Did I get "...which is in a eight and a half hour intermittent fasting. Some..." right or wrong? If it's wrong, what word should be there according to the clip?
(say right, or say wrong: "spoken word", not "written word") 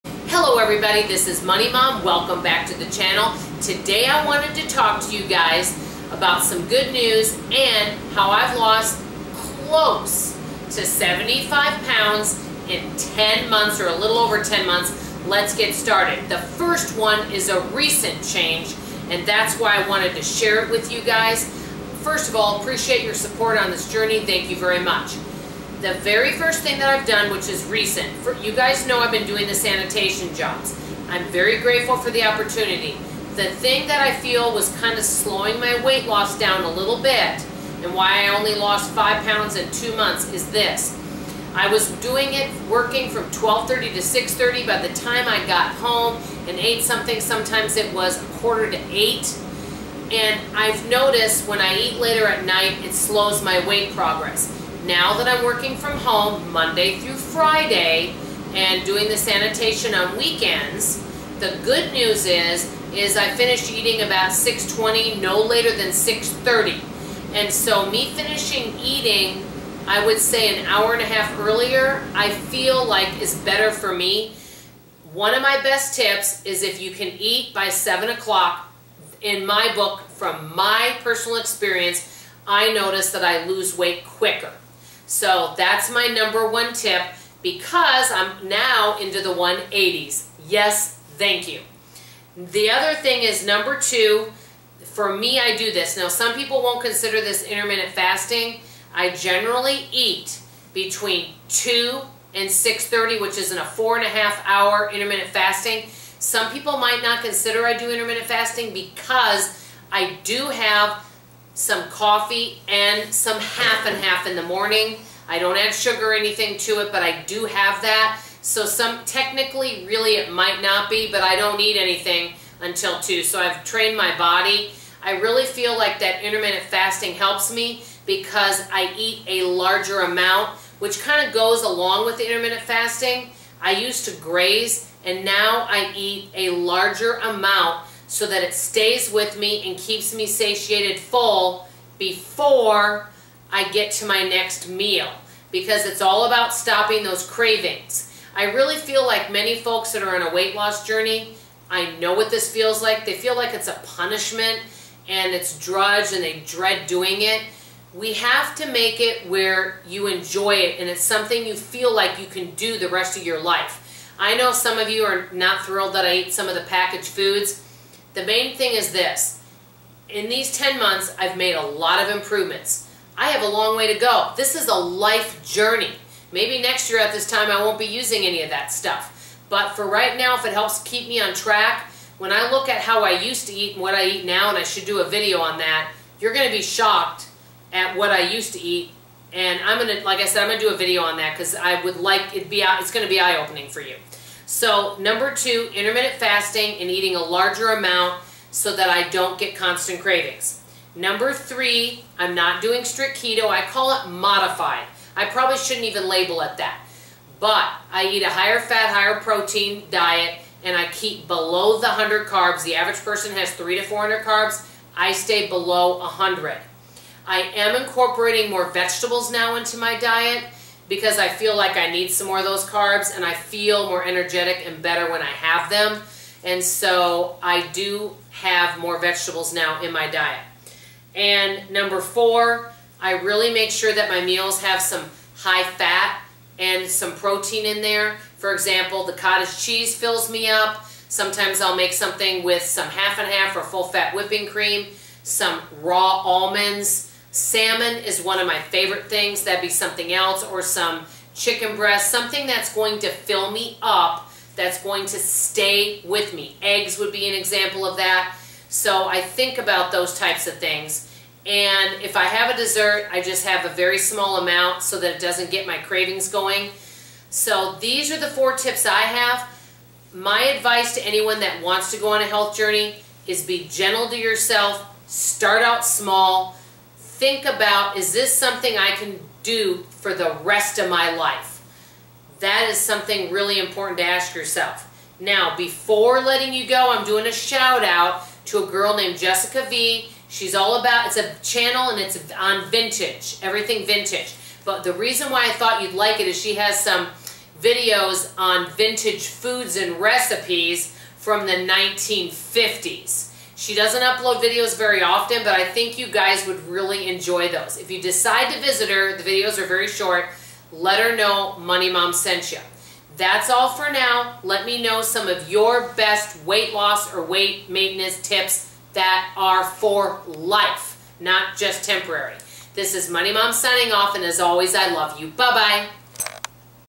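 wrong: "four", not "eight".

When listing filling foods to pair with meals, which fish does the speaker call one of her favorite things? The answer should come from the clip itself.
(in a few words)
Salmon.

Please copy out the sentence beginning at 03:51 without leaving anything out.
And number four, I really make sure that my meals have some high fat and some protein in there.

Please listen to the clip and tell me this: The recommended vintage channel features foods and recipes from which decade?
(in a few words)
1950s.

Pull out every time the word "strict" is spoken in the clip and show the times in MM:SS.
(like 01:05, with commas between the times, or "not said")
03:22.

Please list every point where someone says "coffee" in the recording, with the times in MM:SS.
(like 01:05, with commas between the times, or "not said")
01:51.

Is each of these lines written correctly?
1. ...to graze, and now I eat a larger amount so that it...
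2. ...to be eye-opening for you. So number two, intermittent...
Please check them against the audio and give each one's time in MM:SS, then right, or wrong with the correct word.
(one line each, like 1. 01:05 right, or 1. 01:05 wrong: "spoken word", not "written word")
1. 02:14 right
2. 03:13 right.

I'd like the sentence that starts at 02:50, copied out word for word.
In these 10 months, I've made a lot of improvements.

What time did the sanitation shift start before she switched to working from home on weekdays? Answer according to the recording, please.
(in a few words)
12:30.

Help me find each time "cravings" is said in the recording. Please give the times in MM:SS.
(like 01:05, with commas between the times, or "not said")
02:27, 03:20, 04:25.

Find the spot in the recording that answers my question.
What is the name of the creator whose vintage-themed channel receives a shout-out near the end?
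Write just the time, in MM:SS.
04:49.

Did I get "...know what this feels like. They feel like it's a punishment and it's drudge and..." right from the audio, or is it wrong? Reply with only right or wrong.
right.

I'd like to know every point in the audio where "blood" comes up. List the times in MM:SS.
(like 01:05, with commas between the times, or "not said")
not said.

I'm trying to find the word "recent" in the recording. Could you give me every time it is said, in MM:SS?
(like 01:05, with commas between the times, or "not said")
00:17, 00:27.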